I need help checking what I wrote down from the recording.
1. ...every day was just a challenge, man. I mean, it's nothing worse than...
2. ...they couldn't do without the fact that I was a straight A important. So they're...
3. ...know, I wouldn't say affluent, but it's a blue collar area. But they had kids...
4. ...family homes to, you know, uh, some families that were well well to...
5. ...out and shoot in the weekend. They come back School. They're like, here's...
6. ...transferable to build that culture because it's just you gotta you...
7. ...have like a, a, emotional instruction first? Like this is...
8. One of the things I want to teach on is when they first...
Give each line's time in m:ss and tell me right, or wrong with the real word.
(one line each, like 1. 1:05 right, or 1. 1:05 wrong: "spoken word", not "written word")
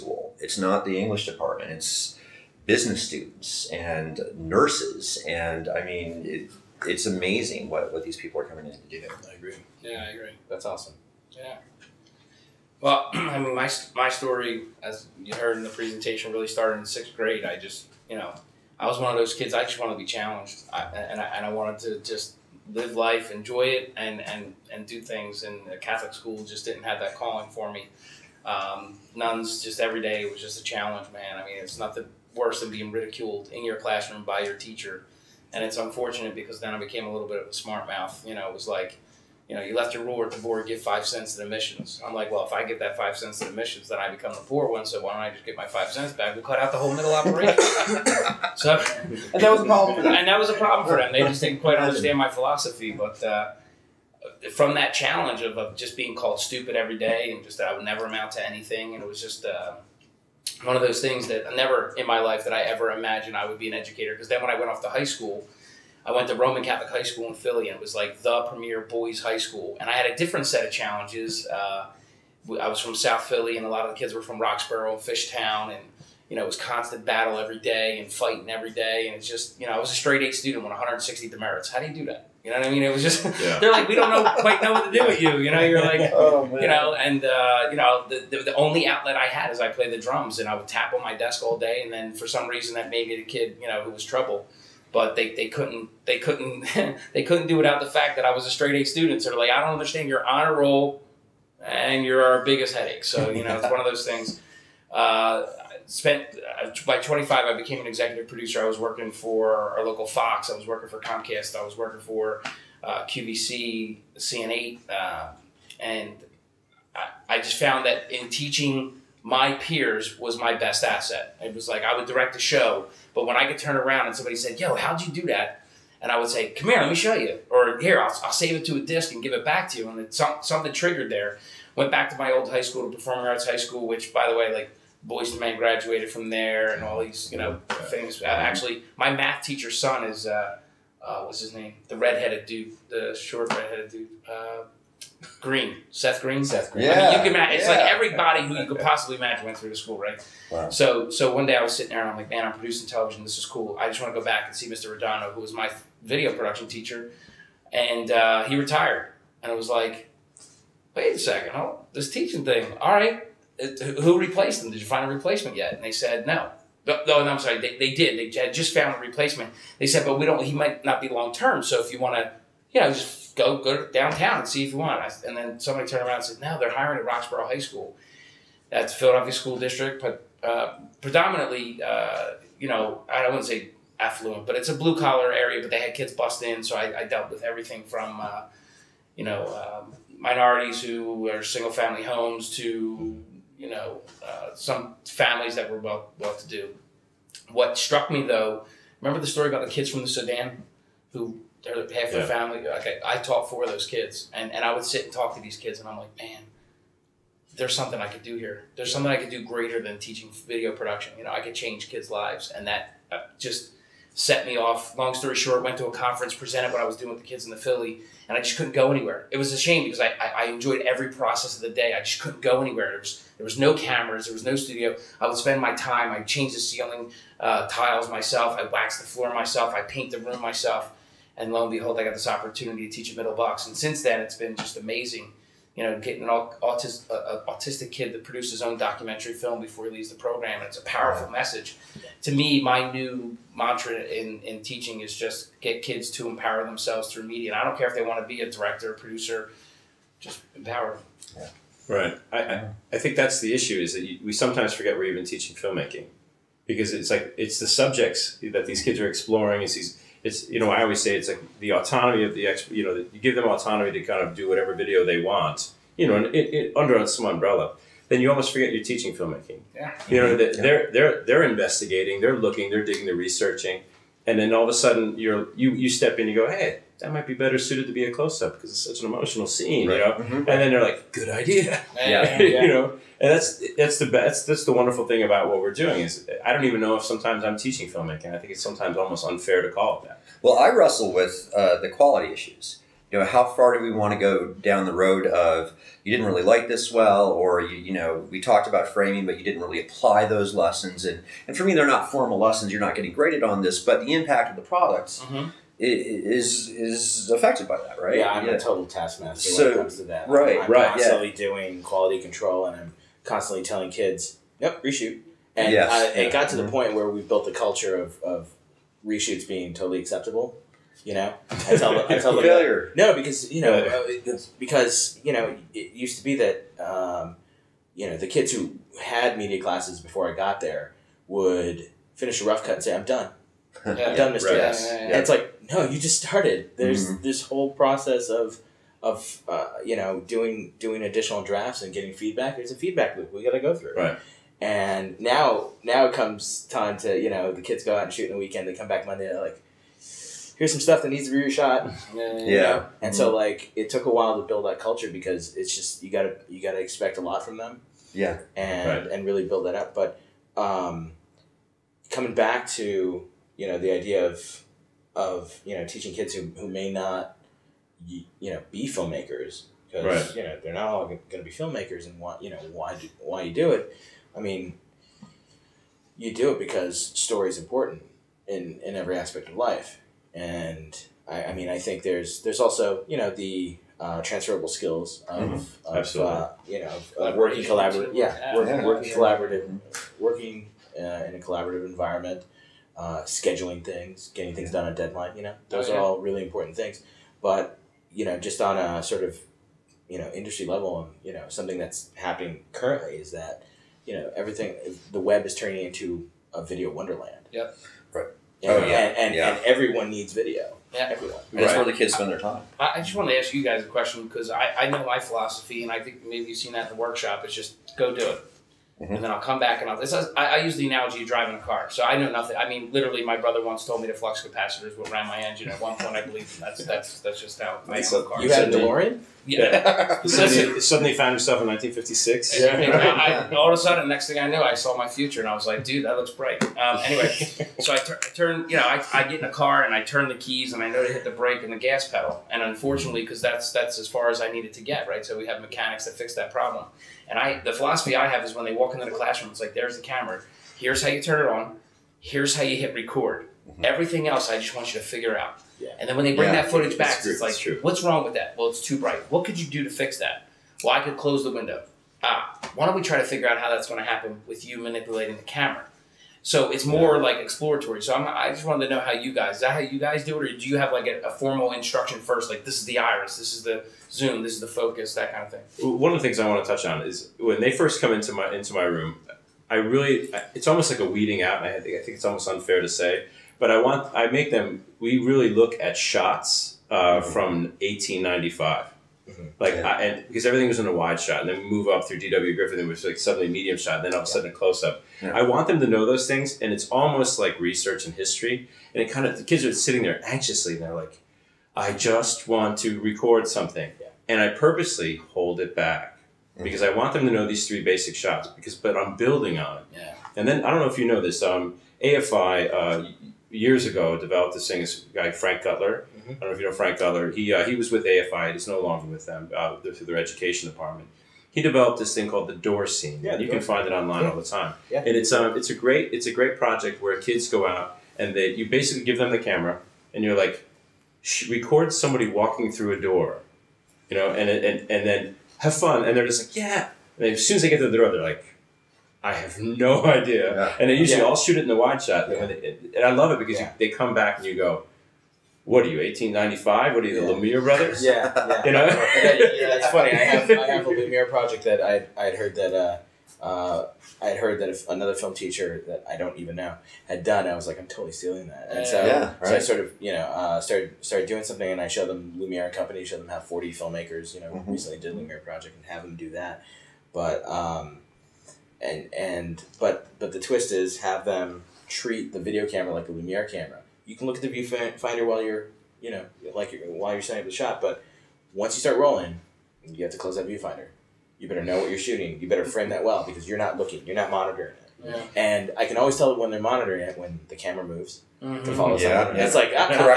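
1. 0:29 right
2. 1:37 wrong: "student", not "important"
3. 3:02 right
4. 3:11 right
5. 5:47 wrong: "Monday", not "School"
6. 5:54 wrong: "while", not "transferable"
7. 7:50 wrong: "formal", not "emotional"
8. 7:55 wrong: "touch", not "teach".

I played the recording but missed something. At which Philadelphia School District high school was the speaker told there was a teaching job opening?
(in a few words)
Roxborough High School.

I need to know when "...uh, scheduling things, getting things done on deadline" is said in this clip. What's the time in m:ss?
6:32.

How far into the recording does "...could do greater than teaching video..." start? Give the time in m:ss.
3:29.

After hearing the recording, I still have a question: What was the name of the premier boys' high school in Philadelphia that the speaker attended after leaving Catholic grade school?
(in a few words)
Roman Catholic High School.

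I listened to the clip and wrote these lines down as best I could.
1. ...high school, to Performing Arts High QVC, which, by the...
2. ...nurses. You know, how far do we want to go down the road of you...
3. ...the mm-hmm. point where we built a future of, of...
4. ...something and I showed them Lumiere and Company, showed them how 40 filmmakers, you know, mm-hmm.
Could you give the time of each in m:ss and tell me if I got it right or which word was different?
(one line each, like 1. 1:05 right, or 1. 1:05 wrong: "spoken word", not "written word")
1. 2:12 wrong: "School", not "QVC"
2. 4:52 wrong: "issues", not "nurses"
3. 5:16 wrong: "culture", not "future"
4. 9:21 right.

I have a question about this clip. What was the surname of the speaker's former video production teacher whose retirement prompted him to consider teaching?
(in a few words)
Redondo.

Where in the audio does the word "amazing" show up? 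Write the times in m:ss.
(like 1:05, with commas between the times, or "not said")
0:07, 3:54.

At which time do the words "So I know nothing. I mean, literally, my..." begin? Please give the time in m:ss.
7:01.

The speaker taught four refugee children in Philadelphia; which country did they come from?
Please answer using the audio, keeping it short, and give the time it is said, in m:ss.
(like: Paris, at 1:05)
Sudan, at 3:20.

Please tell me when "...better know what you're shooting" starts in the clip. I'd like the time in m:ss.
9:41.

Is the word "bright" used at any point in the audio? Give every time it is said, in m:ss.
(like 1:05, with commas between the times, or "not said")
7:16, 7:38.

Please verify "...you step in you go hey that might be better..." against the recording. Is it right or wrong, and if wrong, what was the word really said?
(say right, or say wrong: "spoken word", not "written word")
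right.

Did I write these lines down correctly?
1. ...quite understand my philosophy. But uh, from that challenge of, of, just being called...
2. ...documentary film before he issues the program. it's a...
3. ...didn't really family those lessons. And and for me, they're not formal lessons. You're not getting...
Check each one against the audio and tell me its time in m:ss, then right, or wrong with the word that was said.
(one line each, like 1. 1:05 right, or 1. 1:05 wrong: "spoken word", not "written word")
1. 0:51 right
2. 3:58 wrong: "leaves", not "issues"
3. 4:59 wrong: "apply", not "family".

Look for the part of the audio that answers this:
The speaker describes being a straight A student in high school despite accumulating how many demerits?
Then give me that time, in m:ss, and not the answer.
1:20.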